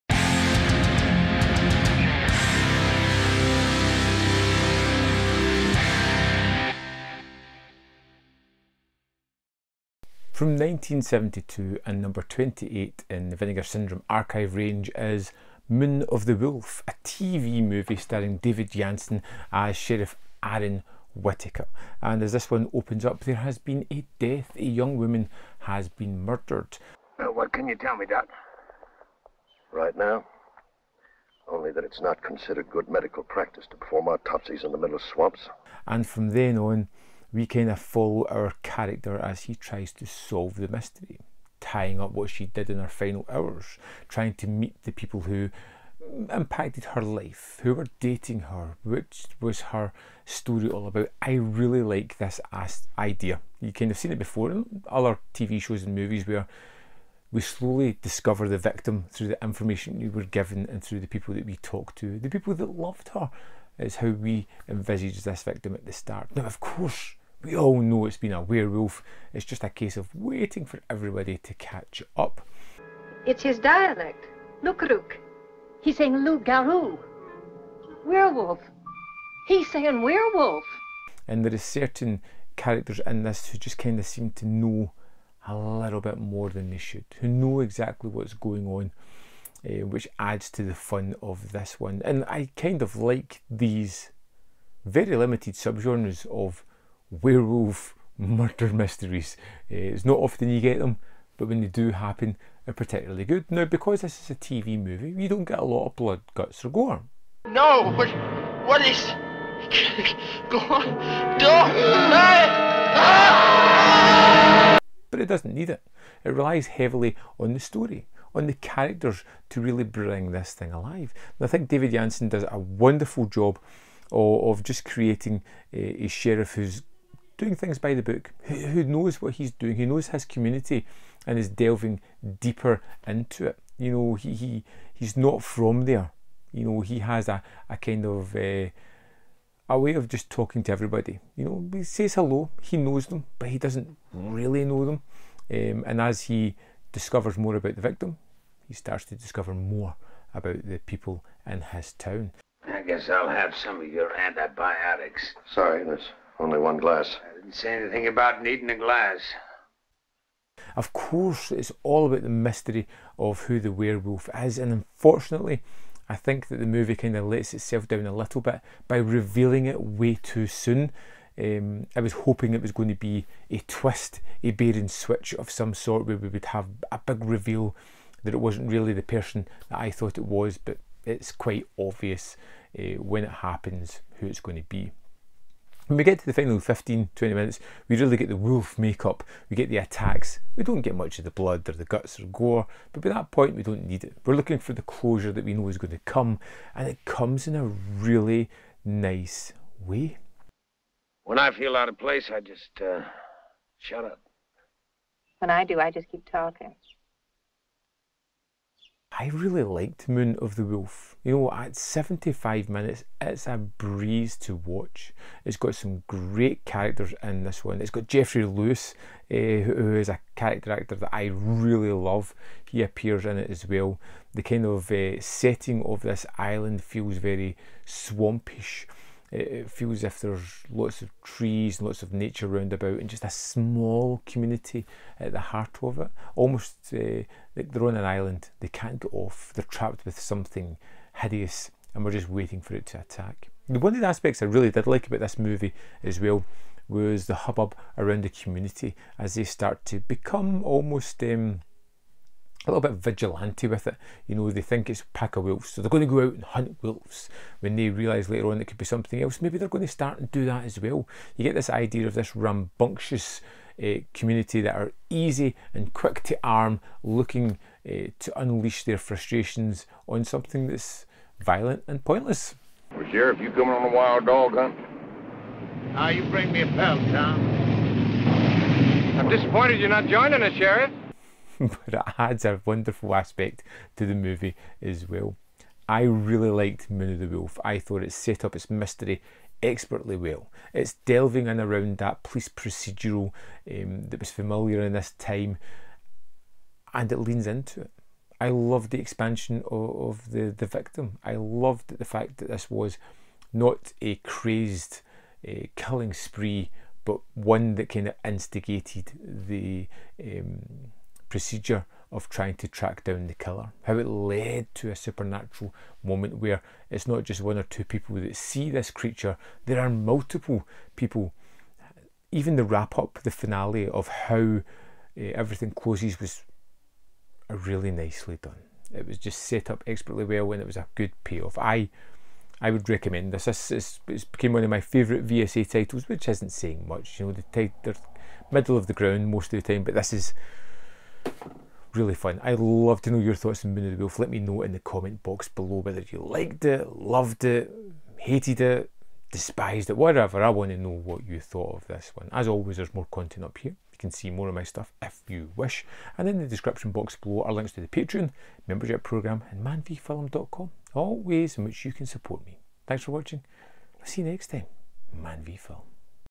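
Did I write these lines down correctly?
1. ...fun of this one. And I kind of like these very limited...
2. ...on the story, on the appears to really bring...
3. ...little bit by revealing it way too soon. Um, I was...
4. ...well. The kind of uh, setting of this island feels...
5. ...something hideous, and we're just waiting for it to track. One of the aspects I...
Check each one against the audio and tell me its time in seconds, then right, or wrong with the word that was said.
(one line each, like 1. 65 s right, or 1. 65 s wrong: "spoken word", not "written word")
1. 90 s right
2. 117 s wrong: "characters", not "appears"
3. 168 s right
4. 223 s right
5. 240 s wrong: "attack", not "track".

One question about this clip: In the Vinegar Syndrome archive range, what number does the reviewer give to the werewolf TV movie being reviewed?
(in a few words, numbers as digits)
28.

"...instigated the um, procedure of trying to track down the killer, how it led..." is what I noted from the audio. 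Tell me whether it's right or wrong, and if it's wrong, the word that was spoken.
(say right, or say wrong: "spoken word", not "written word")
right.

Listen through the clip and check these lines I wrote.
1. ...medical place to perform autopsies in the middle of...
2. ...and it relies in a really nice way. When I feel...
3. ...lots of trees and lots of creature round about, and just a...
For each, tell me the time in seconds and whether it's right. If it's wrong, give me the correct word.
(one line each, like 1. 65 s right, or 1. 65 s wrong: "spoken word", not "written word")
1. 32 s wrong: "practice", not "place"
2. 196 s wrong: "comes", not "relies"
3. 230 s wrong: "nature", not "creature".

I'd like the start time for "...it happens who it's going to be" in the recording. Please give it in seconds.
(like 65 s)
183 s.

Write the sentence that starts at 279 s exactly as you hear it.
I'm disappointed you're not joining us, Sheriff.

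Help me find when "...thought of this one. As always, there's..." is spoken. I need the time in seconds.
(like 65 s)
351 s.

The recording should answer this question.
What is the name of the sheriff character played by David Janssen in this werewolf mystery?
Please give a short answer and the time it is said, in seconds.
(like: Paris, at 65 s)
Aaron Whittaker, at 20 s.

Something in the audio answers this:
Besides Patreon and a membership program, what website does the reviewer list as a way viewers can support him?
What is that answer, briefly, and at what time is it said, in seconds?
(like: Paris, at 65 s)
manvfilm.com, at 359 s.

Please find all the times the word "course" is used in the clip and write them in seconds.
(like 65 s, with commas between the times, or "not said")
66 s, 160 s.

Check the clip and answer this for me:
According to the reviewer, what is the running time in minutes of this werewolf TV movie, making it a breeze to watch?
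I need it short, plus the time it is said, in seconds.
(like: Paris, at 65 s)
75, at 211 s.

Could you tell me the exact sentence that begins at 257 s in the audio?
When they realise later on it could be something else, maybe they're going to start and do that as well.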